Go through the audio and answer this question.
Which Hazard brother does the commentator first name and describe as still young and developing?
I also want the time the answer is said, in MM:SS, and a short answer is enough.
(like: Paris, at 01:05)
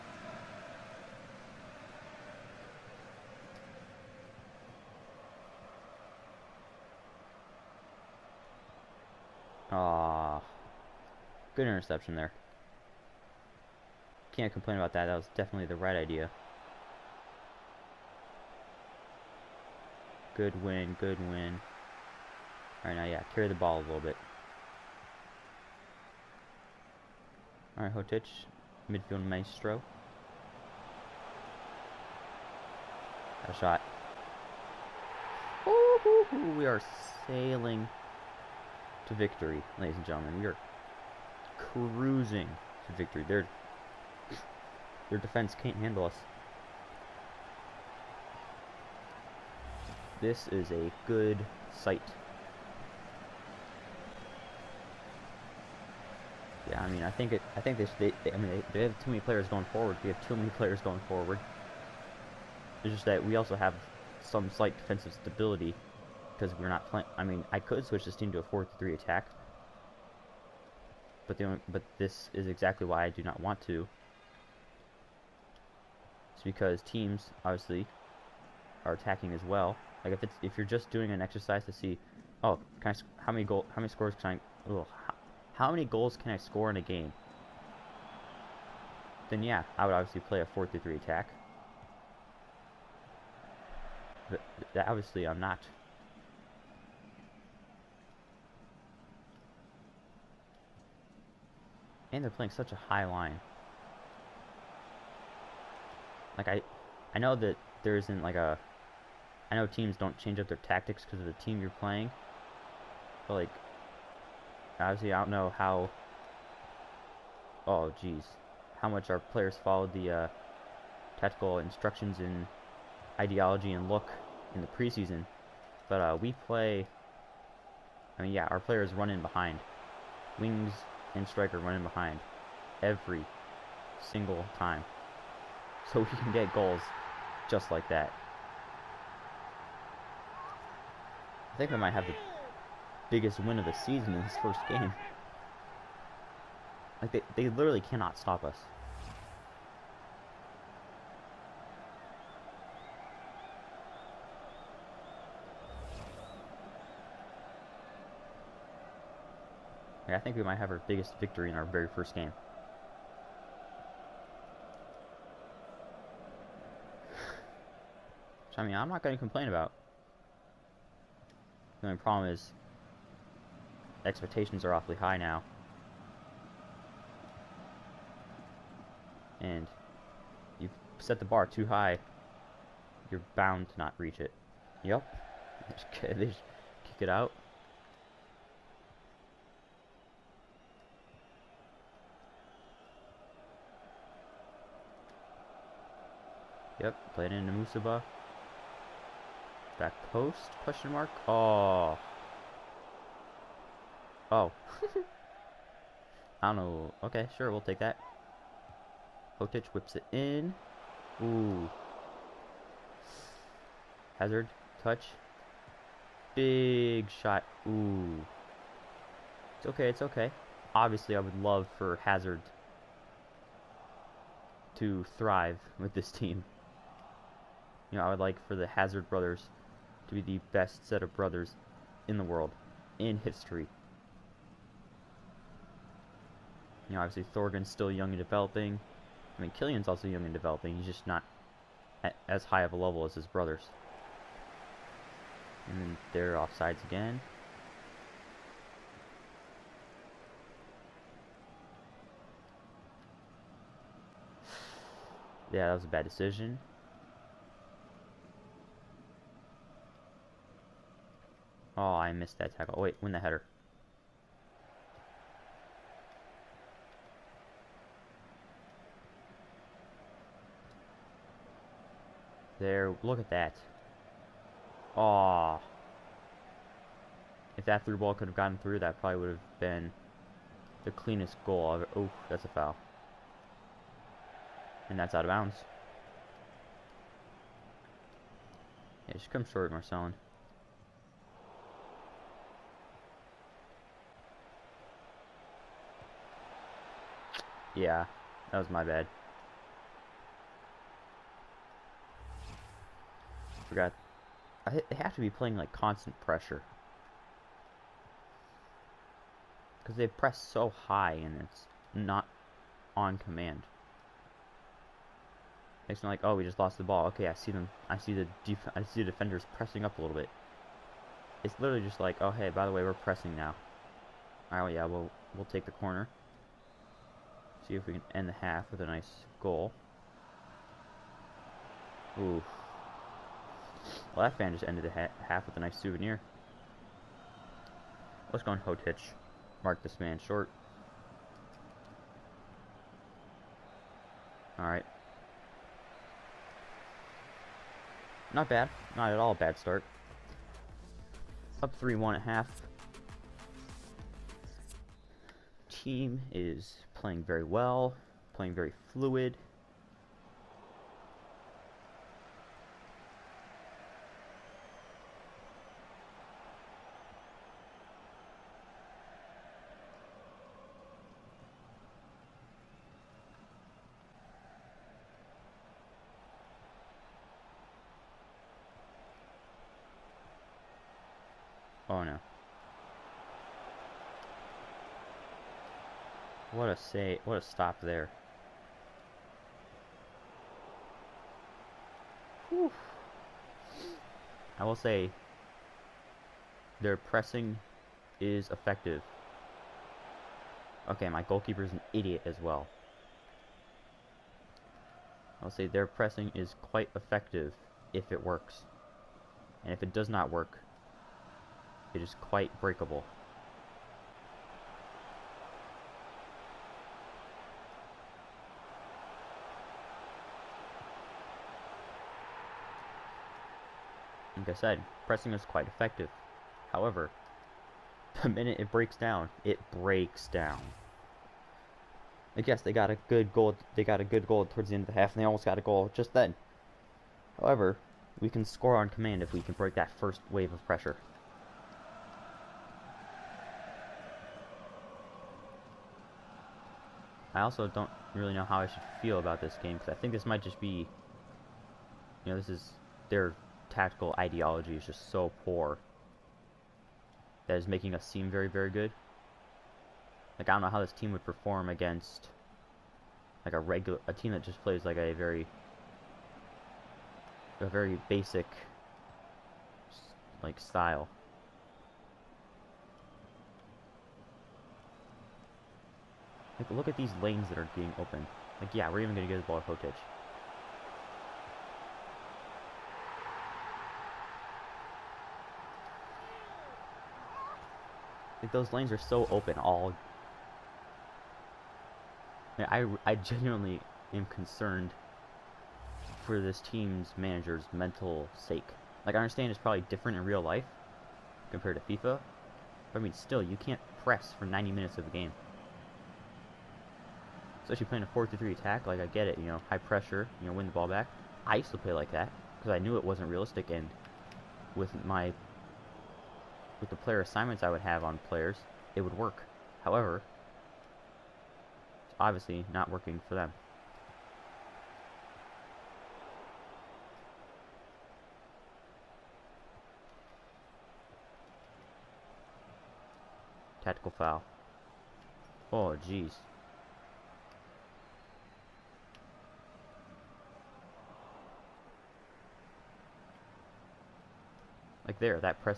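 Thorgan, at 03:57.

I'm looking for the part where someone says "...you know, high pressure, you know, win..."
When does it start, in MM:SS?
08:29.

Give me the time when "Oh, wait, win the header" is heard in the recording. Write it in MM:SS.
04:22.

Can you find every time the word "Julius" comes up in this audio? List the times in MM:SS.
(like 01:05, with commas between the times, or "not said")
not said.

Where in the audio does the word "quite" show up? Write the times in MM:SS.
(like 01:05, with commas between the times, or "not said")
06:46, 06:52, 07:05.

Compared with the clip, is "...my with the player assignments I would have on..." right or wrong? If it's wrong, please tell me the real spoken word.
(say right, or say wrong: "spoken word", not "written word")
right.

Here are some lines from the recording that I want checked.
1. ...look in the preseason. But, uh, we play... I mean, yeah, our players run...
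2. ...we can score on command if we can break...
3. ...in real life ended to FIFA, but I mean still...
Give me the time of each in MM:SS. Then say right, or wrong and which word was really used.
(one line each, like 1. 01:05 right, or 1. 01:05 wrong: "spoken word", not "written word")
1. 02:03 right
2. 07:18 right
3. 08:20 wrong: "compared", not "ended".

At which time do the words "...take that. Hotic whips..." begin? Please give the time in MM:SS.
03:27.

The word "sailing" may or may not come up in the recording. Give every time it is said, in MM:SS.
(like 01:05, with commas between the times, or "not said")
00:37.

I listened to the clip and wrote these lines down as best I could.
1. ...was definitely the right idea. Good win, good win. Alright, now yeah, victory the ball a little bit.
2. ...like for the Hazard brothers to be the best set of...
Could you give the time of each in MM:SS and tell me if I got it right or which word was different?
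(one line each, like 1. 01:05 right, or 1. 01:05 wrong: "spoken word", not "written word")
1. 00:15 wrong: "carry", not "victory"
2. 03:48 right.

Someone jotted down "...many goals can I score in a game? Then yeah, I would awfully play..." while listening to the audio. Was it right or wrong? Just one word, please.
wrong.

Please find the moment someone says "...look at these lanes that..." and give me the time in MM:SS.
07:56.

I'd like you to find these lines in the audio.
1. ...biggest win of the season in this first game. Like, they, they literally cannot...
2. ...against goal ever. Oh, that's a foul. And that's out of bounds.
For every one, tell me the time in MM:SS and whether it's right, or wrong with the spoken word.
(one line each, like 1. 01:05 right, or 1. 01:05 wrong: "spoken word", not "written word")
1. 02:23 right
2. 04:40 wrong: "cleanest", not "against".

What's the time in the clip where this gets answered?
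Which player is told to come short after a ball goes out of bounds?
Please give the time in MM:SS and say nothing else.
04:49.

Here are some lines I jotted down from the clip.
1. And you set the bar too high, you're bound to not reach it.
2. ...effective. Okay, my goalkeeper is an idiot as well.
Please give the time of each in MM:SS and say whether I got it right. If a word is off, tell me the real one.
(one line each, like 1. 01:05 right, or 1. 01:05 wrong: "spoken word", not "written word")
1. 02:59 right
2. 06:38 right.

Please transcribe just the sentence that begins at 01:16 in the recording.
It's because teams obviously are attacking as well.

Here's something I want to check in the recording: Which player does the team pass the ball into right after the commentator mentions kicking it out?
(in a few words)
Musaba.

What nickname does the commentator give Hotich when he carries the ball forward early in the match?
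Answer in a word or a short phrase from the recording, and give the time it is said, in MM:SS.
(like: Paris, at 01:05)
midfield maestro, at 00:28.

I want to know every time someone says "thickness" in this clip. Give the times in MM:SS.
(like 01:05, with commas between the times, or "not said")
not said.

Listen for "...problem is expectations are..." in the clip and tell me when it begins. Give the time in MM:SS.
02:51.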